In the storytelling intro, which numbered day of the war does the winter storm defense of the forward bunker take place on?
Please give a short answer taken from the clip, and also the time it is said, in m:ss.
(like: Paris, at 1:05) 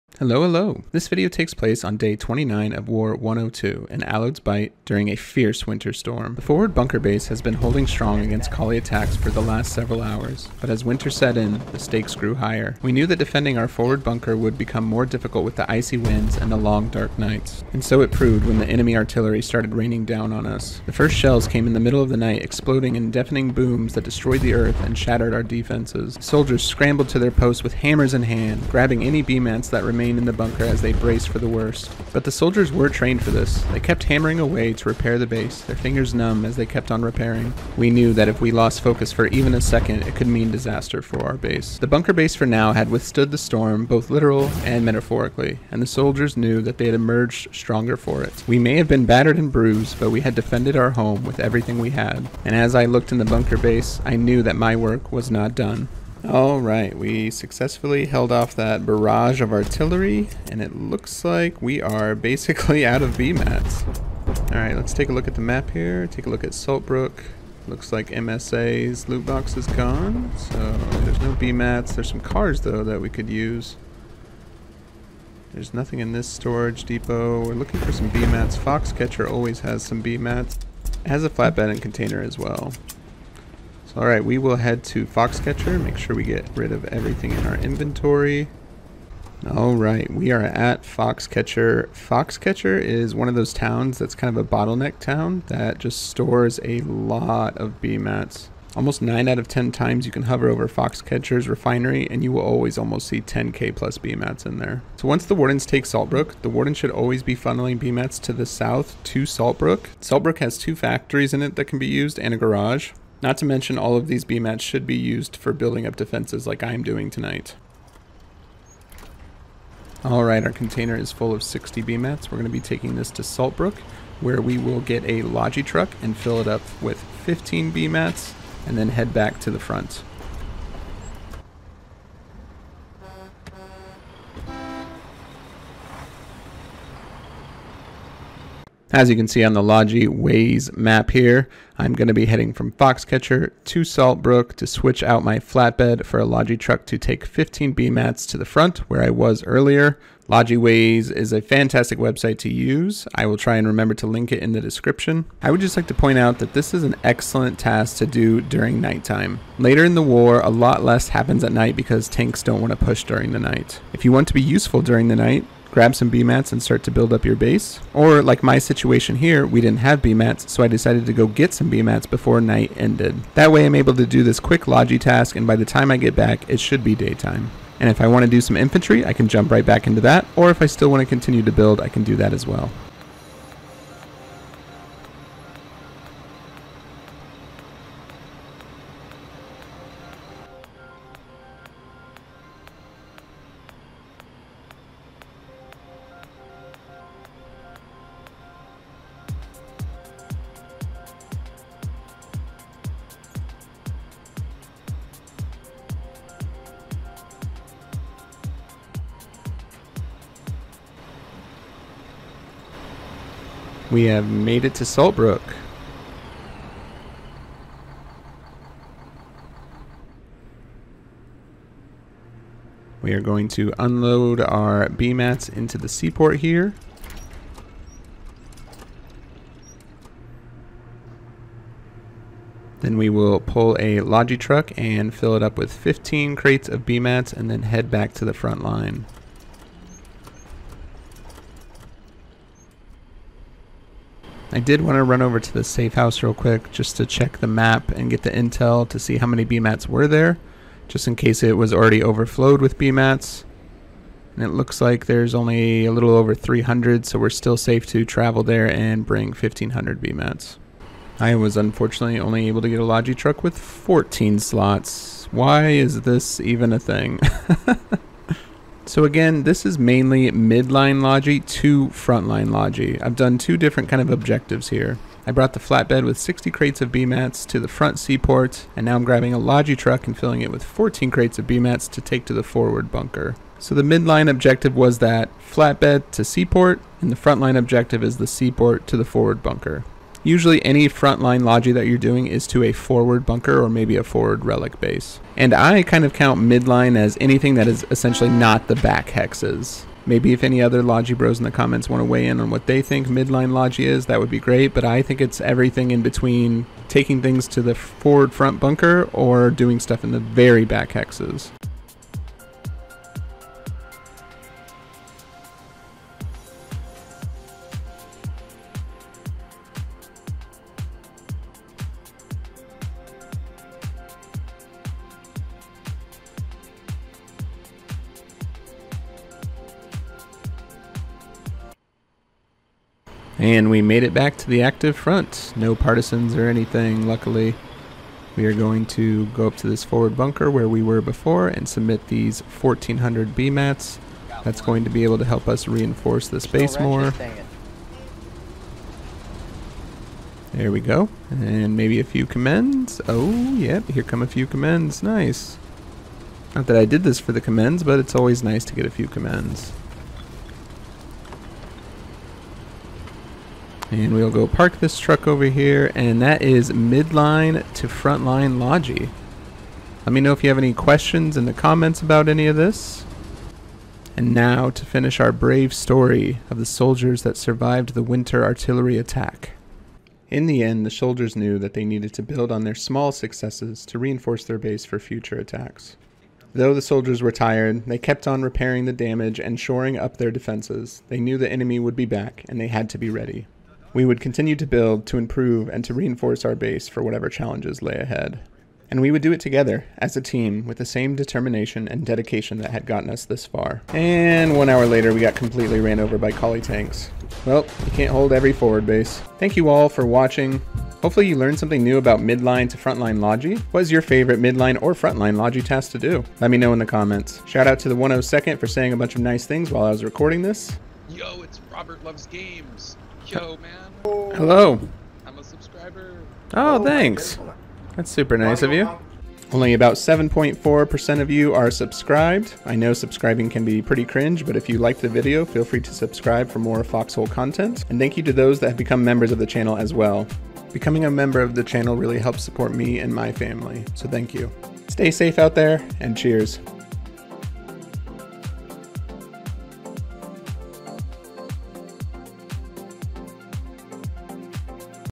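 29, at 0:01.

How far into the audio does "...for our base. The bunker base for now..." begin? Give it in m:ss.
0:41.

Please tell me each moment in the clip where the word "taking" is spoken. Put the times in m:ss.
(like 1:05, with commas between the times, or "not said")
2:02, 5:06.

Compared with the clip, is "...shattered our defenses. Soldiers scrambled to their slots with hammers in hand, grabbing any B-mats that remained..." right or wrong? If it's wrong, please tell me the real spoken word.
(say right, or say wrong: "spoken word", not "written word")
wrong: "posts", not "slots".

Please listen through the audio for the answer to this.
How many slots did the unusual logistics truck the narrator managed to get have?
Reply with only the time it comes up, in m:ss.
4:23.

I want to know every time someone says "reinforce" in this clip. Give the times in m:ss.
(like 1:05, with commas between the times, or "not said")
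5:45, 6:23, 6:35.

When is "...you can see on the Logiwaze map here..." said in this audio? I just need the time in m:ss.
2:19.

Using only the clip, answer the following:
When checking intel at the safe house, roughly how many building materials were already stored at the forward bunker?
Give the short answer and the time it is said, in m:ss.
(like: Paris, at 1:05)
a little over 300, at 4:15.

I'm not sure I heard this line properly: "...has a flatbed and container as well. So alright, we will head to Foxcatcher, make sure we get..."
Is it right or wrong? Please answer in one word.
right.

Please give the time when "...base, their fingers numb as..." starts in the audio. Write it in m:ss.
0:35.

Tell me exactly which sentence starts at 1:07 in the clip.
Looks like MSA's loot box is gone, so there's no B-mats.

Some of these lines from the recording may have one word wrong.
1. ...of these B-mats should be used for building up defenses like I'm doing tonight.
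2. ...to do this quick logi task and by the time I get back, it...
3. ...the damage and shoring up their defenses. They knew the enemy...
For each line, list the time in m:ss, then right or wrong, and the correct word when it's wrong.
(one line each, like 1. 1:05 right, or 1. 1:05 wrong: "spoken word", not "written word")
1. 1:53 right
2. 2:53 right
3. 6:28 right.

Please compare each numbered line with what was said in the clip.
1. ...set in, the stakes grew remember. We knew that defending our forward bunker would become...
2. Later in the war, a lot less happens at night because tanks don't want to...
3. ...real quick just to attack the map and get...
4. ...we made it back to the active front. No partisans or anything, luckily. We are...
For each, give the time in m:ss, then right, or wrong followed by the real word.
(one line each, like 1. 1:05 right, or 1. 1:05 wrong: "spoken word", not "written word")
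1. 0:11 wrong: "higher", not "remember"
2. 2:39 right
3. 4:06 wrong: "check", not "attack"
4. 5:33 right.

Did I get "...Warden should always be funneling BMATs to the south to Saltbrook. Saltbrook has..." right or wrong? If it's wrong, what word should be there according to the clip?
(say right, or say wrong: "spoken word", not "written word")
right.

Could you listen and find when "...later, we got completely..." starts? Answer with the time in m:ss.
6:44.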